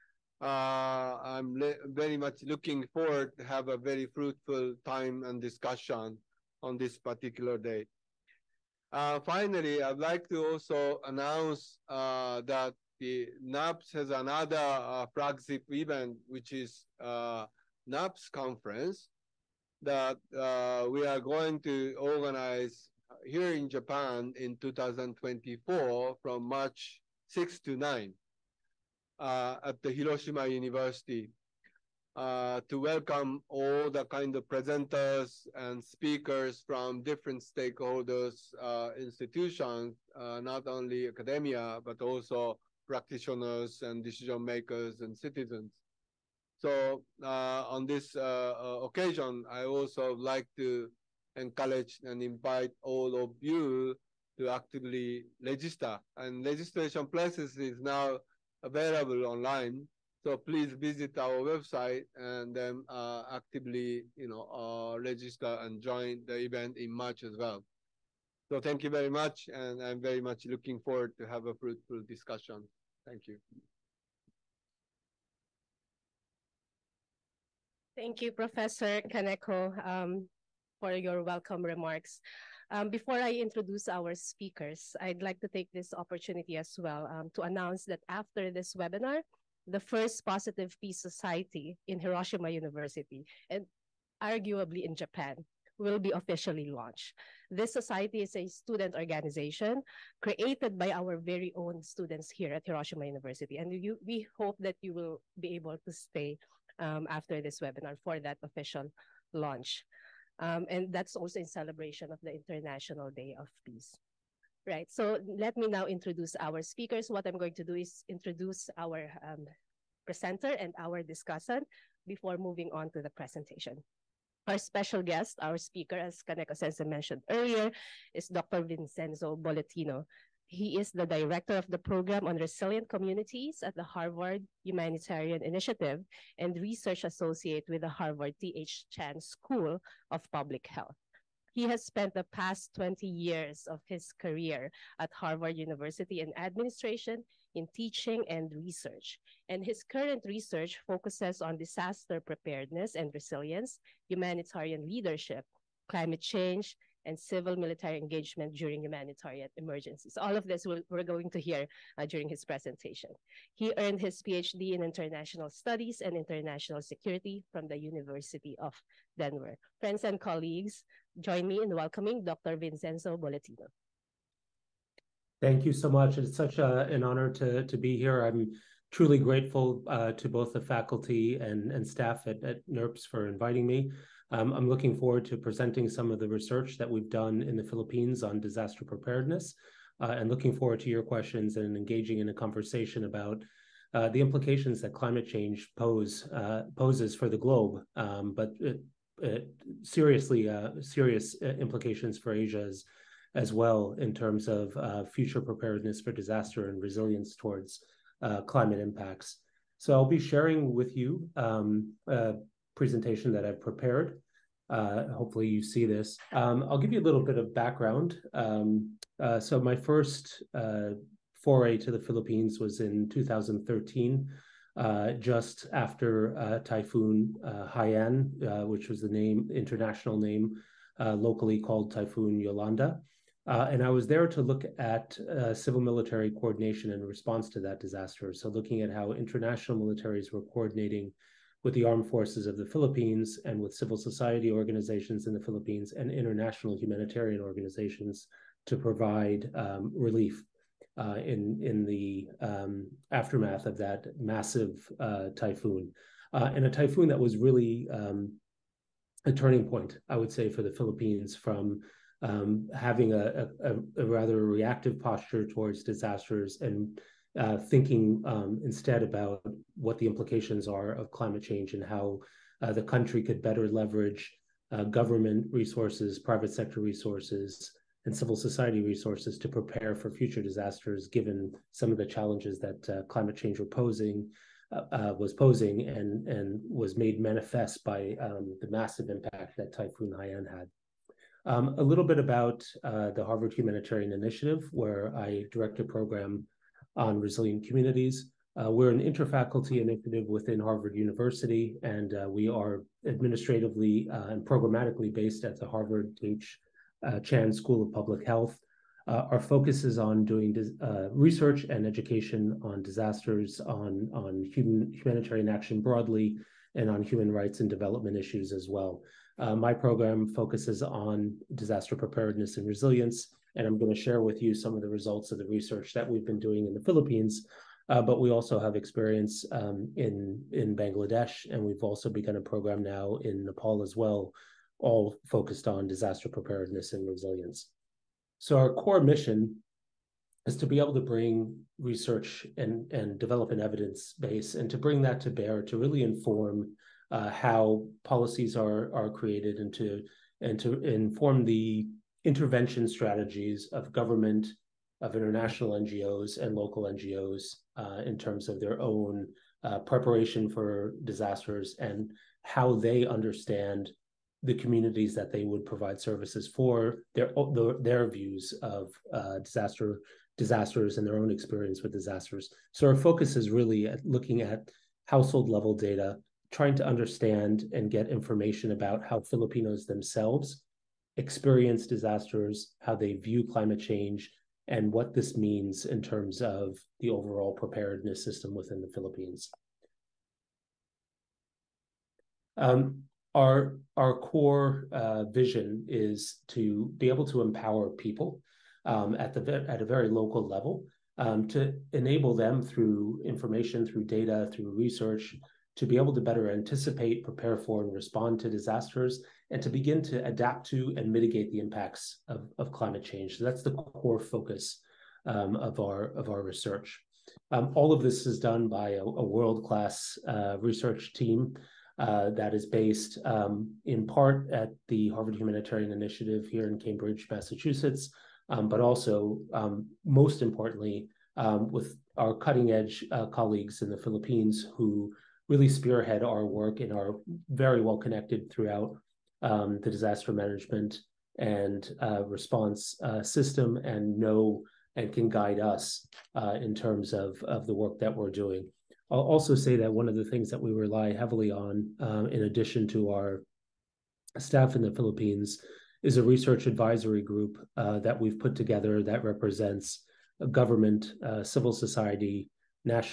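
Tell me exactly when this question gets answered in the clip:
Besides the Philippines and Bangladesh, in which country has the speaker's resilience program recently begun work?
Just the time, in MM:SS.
05:33.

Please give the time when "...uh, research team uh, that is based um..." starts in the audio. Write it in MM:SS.
07:00.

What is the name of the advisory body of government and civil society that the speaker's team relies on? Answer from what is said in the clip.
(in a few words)
research advisory group.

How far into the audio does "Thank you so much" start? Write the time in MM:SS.
02:55.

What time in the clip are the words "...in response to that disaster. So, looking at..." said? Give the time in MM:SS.
03:56.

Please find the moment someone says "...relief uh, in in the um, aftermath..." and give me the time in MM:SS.
04:09.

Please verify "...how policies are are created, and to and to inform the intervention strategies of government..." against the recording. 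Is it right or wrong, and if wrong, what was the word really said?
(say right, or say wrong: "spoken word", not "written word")
right.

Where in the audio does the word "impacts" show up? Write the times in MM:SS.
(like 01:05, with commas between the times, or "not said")
03:28, 04:49, 06:51.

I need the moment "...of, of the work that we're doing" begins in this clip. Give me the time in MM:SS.
07:27.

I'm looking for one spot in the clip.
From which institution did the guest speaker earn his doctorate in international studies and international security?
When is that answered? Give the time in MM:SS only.
02:47.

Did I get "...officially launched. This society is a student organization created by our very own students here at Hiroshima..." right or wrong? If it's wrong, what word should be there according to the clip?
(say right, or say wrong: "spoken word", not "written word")
right.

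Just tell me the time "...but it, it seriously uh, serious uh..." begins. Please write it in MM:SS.
03:18.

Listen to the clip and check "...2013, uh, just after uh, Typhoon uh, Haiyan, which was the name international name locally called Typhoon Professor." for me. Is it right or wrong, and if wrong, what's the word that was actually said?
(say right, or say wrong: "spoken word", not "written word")
wrong: "Yolanda", not "Professor".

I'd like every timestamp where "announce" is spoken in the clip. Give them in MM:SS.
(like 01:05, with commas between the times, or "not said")
00:11, 01:27.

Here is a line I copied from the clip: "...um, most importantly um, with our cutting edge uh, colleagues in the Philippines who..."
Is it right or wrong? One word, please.
right.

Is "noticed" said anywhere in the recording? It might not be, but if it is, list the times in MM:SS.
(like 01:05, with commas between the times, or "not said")
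not said.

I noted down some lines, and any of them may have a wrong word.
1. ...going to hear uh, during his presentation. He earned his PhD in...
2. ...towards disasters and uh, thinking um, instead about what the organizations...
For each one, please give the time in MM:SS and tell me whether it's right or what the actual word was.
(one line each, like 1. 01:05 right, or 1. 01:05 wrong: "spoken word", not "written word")
1. 02:41 right
2. 04:25 wrong: "implications", not "organizations".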